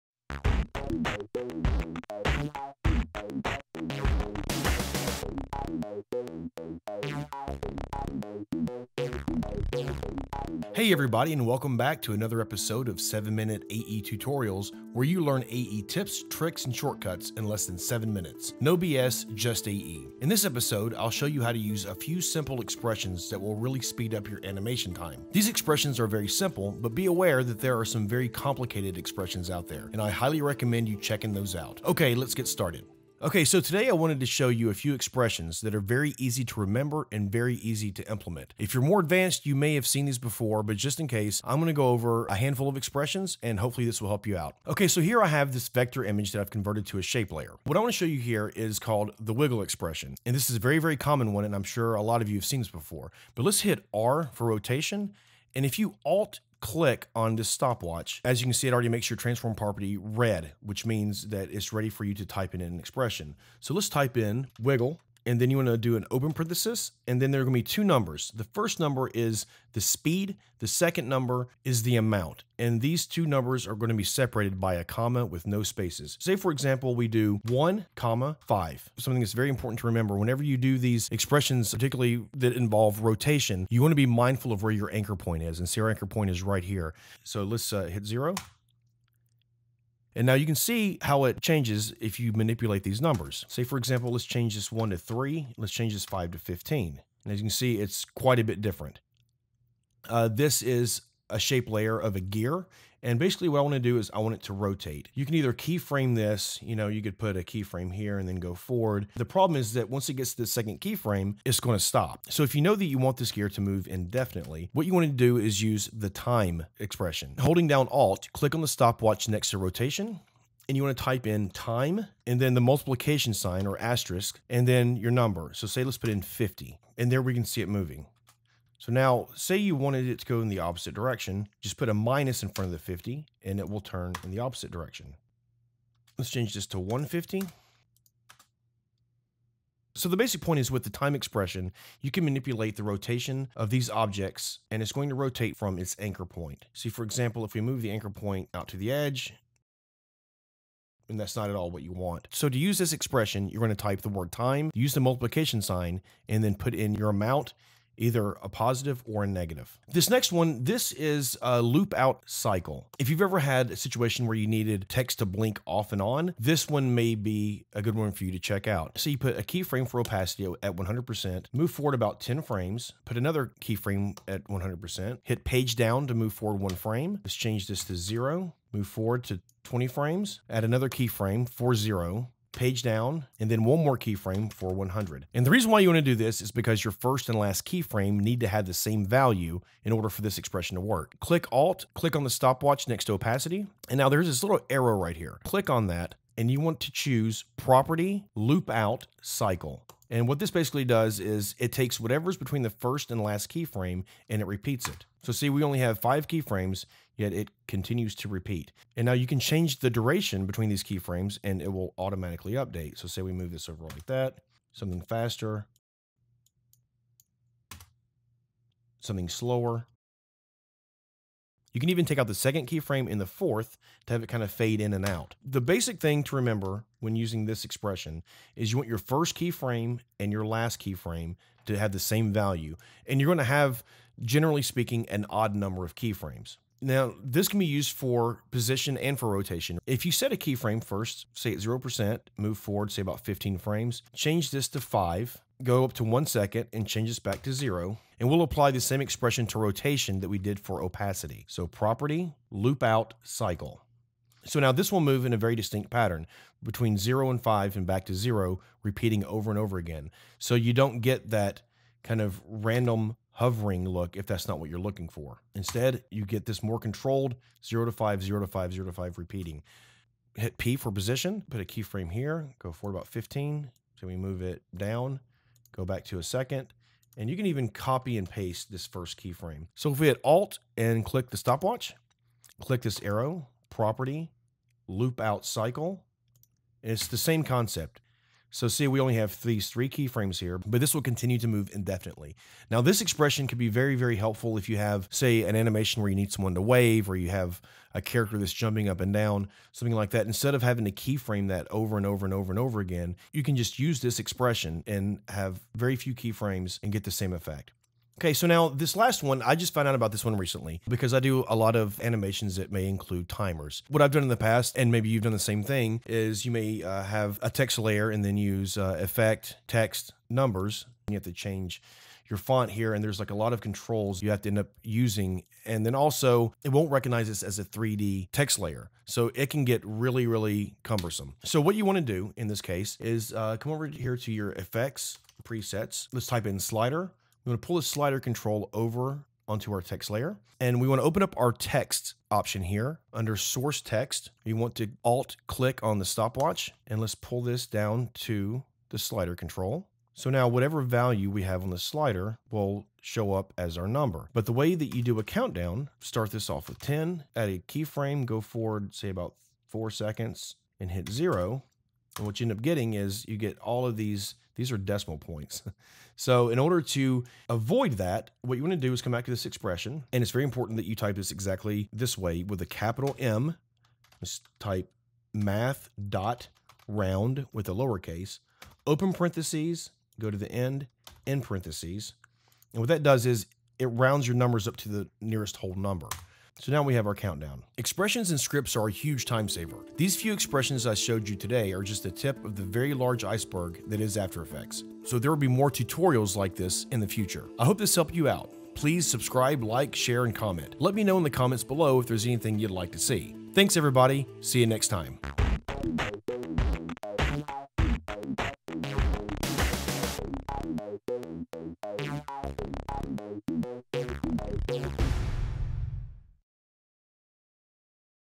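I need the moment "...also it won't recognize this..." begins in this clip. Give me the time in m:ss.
5:25.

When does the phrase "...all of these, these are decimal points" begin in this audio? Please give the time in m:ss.
6:03.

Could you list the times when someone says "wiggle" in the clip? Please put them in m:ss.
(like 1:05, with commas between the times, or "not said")
0:49, 1:04.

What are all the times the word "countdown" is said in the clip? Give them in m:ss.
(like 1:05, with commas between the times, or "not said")
5:55, 6:27.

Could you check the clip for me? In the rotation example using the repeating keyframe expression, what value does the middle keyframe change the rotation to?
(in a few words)
5.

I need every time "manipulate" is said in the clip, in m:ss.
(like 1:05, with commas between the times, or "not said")
1:32, 2:22.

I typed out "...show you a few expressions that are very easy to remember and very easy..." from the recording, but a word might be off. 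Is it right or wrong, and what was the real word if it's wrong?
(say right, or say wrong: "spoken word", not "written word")
right.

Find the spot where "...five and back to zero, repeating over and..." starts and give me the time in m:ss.
4:17.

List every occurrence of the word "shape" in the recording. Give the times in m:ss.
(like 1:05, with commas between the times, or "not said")
0:47, 1:41.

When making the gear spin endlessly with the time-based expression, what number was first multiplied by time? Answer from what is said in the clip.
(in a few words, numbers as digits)
50.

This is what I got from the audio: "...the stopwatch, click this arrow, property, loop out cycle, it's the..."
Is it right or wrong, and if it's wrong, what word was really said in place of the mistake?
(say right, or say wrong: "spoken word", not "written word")
right.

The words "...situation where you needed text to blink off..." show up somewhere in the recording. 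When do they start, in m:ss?
2:43.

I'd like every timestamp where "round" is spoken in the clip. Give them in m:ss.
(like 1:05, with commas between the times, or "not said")
6:16, 6:23.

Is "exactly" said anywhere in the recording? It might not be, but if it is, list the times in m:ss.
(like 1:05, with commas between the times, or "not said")
6:11.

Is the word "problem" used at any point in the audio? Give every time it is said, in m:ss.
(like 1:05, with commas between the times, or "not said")
1:49.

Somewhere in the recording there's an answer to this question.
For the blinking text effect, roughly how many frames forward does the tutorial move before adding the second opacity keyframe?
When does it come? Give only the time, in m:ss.
2:51.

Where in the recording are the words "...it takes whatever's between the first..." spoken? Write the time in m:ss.
3:21.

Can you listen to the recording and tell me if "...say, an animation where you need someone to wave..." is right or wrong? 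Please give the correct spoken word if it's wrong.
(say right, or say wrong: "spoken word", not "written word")
right.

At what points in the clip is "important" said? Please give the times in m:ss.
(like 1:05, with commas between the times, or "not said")
1:19, 6:10.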